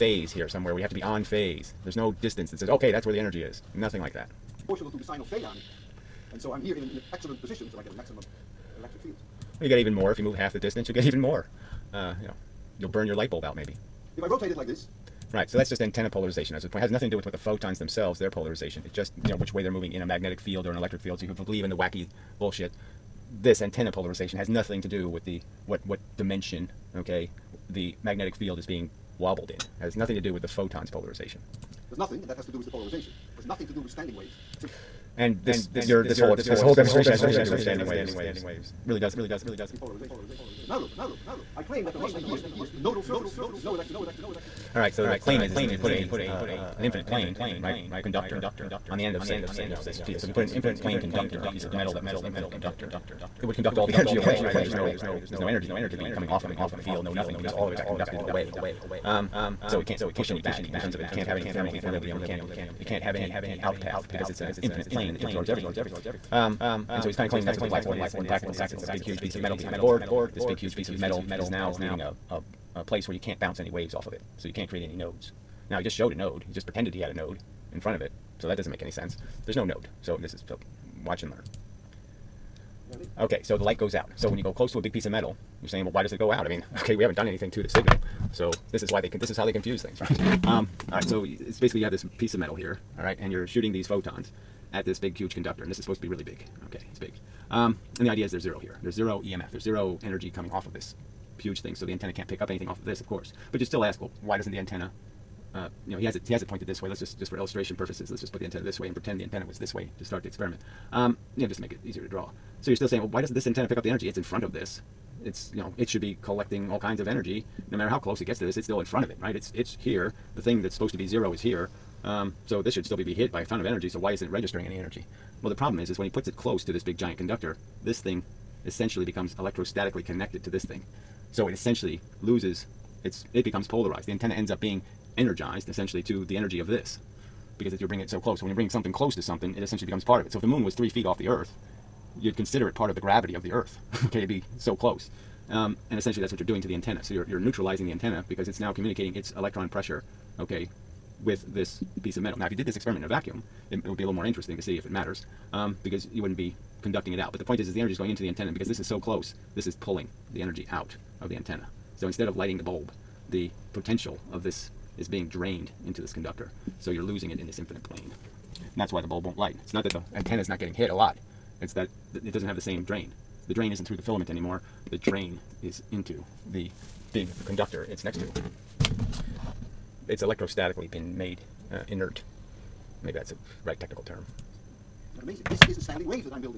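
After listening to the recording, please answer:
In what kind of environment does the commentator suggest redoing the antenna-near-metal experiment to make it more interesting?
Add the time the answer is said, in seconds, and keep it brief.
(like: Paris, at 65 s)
a vacuum, at 153 s.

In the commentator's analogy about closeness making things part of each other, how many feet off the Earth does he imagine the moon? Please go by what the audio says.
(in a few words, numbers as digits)
3.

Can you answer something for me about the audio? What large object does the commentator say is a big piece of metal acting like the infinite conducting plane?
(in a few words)
the blackboard.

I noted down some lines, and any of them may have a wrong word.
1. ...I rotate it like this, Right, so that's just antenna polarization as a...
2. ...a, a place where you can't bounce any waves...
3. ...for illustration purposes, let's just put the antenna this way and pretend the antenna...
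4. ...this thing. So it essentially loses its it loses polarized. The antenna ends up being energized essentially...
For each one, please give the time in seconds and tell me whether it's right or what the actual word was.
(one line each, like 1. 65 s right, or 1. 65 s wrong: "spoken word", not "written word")
1. 14 s right
2. 72 s right
3. 107 s right
4. 130 s wrong: "becomes", not "loses".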